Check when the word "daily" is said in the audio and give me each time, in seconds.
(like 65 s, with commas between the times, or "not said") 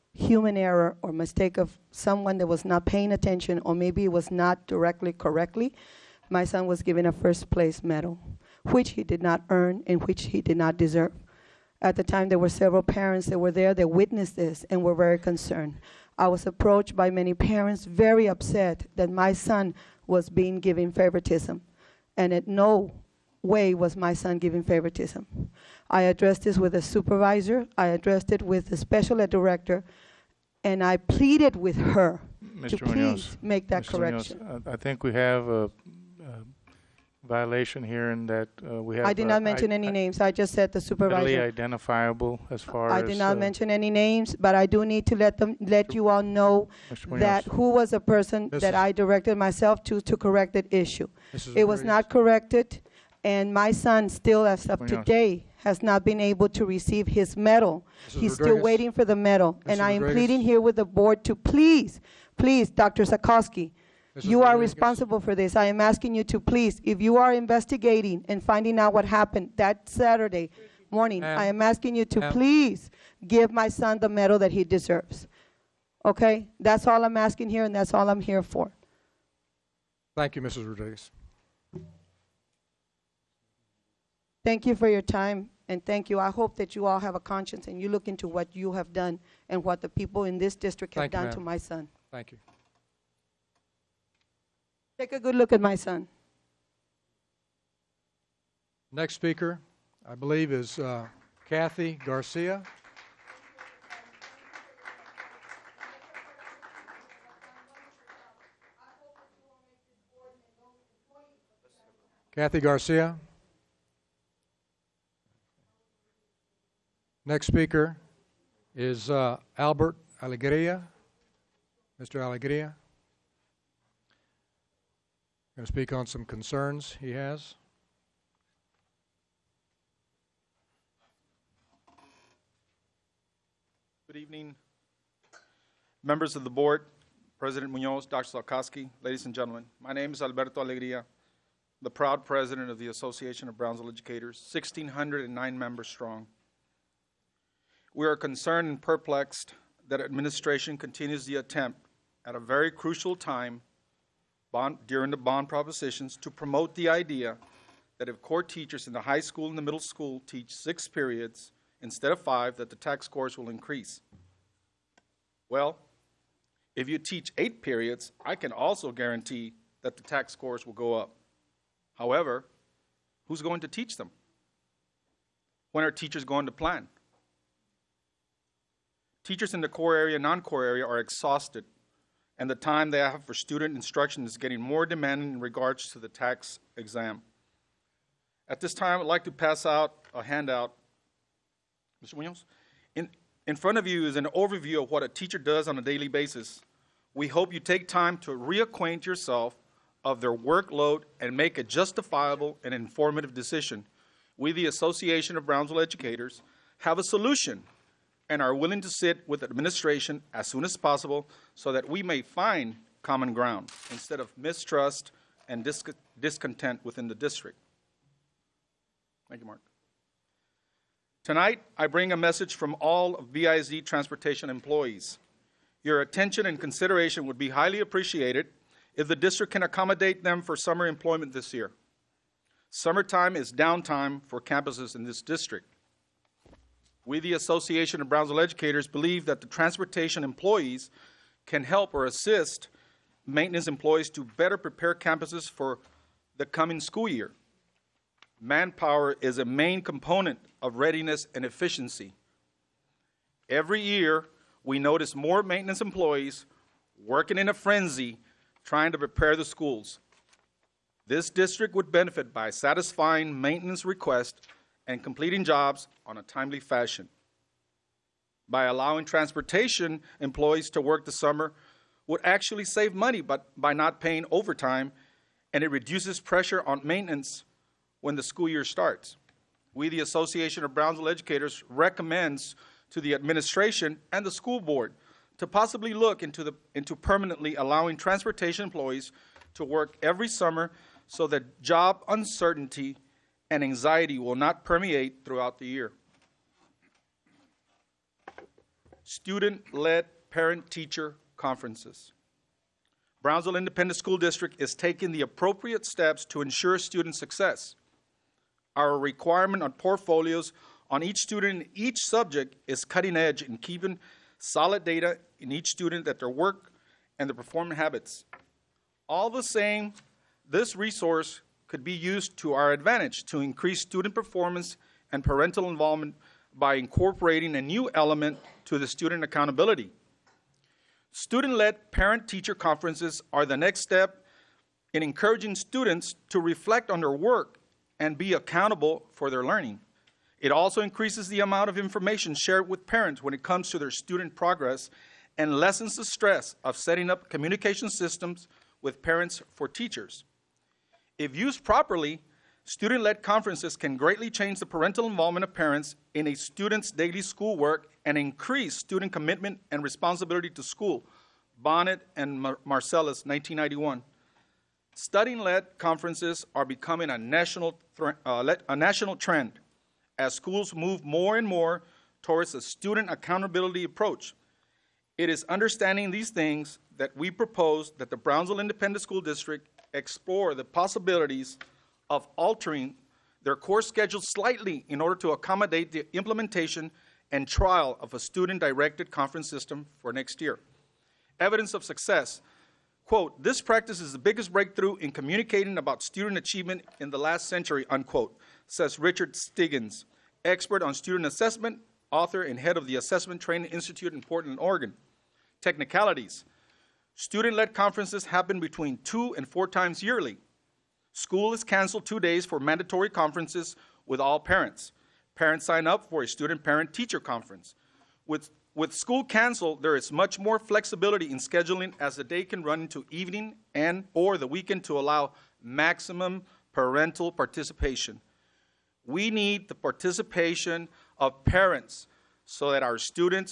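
195 s, 356 s.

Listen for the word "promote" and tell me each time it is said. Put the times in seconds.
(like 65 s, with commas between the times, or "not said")
156 s.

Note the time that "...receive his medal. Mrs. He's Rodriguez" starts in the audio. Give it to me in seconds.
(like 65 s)
56 s.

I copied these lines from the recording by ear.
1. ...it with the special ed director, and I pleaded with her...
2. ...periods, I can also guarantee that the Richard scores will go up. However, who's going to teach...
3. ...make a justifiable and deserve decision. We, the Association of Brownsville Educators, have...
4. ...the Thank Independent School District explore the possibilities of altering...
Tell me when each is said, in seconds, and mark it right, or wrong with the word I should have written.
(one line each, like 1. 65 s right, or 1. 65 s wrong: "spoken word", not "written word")
1. 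28 s right
2. 167 s wrong: "TAKS", not "Richard"
3. 201 s wrong: "informative", not "deserve"
4. 378 s wrong: "Brownsville", not "Thank".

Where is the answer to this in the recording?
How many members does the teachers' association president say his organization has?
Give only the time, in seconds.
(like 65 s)
144 s.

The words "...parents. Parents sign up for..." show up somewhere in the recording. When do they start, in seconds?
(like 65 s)
414 s.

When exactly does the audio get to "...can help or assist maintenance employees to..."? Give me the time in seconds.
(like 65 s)
241 s.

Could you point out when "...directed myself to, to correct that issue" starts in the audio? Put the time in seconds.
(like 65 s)
48 s.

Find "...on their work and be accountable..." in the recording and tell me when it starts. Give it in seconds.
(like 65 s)
336 s.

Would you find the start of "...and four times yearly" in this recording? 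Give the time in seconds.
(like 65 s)
409 s.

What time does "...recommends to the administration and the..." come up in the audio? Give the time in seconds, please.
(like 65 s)
281 s.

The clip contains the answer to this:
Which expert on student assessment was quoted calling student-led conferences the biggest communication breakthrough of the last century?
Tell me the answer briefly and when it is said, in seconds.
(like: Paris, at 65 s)
Richard Stiggins, at 398 s.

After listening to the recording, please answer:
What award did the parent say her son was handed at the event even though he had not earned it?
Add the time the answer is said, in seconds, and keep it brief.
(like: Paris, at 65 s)
first place medal, at 7 s.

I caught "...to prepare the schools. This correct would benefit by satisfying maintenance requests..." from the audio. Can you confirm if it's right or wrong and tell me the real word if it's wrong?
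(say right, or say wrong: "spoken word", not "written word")
wrong: "district", not "correct".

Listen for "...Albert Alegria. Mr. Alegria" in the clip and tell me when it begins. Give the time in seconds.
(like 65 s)
119 s.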